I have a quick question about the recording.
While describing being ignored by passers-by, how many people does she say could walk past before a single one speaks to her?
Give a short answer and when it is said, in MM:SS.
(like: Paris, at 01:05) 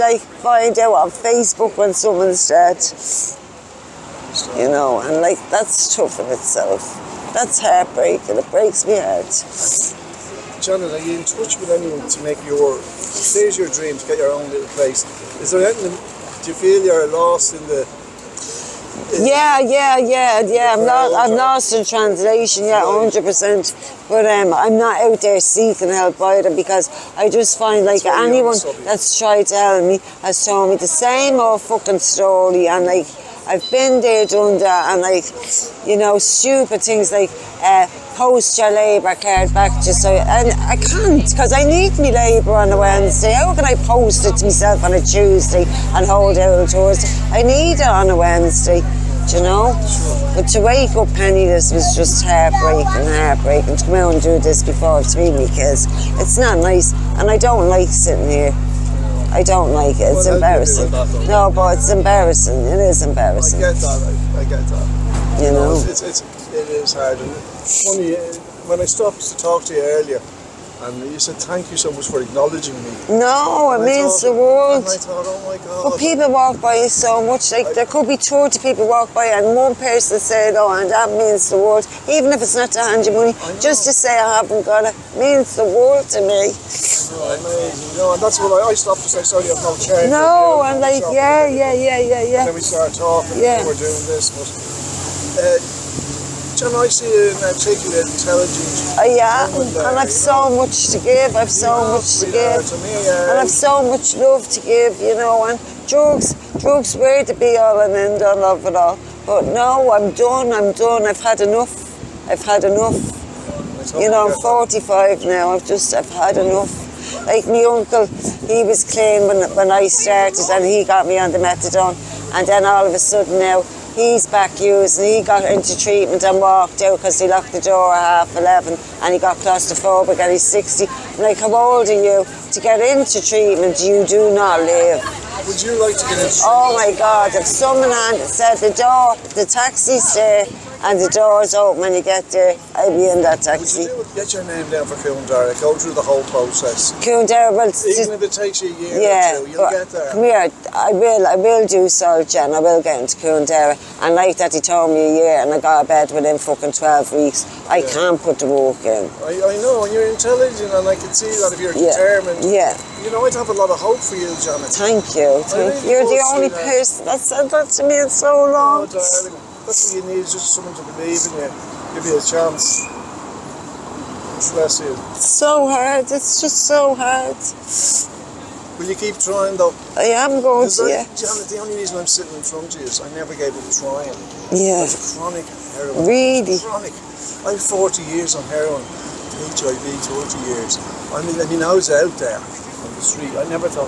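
20, at 01:18.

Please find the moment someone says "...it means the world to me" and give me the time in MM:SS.
01:24.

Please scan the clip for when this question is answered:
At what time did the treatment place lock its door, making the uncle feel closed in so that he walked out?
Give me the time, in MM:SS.
02:08.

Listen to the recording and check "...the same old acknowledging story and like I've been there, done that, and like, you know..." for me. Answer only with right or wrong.
wrong.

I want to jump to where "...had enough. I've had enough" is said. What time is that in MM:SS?
01:51.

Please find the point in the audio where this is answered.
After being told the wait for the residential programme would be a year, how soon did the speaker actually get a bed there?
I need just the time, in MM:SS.
02:36.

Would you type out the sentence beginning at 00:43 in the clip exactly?
How can I post it to myself on a Tuesday and hold out towards?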